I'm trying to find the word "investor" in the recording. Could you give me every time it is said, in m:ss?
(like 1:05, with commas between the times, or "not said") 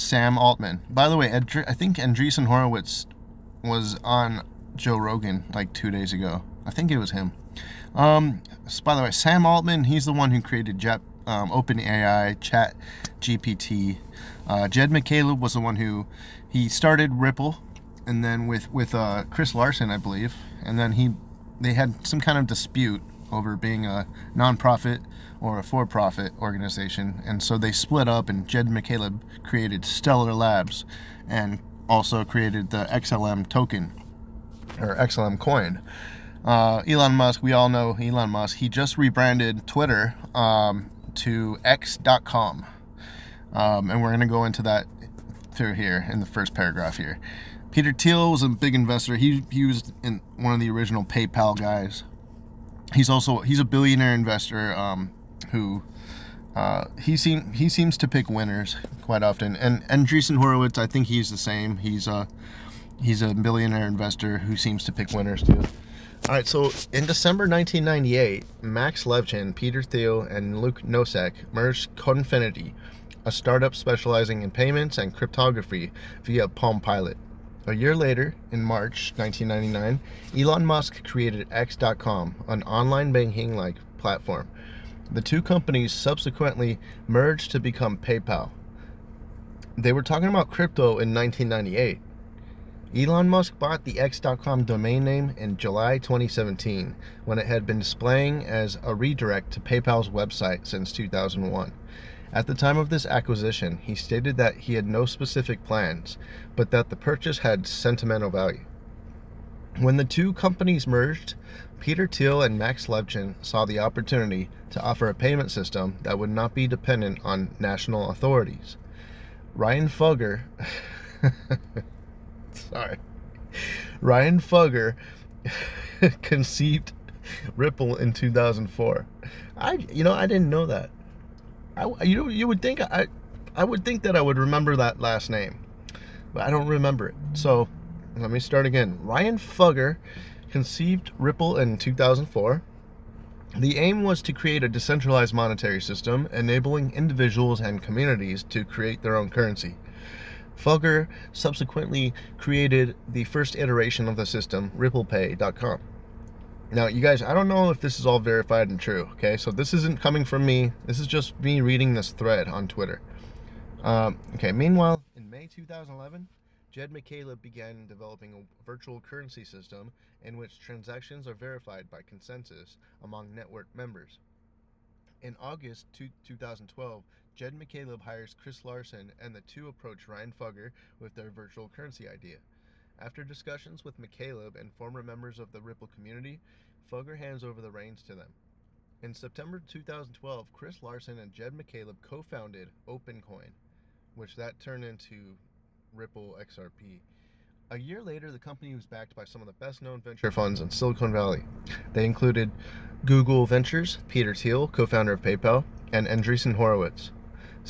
0:48, 0:54, 1:03.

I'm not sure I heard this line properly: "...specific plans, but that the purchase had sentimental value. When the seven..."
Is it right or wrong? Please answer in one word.
wrong.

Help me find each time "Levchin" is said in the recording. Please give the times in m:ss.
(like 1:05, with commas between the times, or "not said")
1:09, 1:52.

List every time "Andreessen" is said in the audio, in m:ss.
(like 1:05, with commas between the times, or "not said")
0:01, 1:00, 3:26.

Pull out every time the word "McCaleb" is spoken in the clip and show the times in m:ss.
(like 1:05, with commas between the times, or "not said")
0:14, 0:28, 2:46, 2:57, 3:03, 3:11.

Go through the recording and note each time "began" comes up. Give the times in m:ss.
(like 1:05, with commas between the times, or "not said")
2:47.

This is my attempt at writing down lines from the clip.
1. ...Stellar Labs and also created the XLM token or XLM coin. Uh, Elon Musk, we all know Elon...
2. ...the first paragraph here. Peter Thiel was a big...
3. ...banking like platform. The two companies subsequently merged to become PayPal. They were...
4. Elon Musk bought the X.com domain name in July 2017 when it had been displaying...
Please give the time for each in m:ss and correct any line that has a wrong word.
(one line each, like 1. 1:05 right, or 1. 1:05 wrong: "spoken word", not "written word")
1. 0:29 right
2. 0:46 right
3. 1:23 right
4. 1:32 right.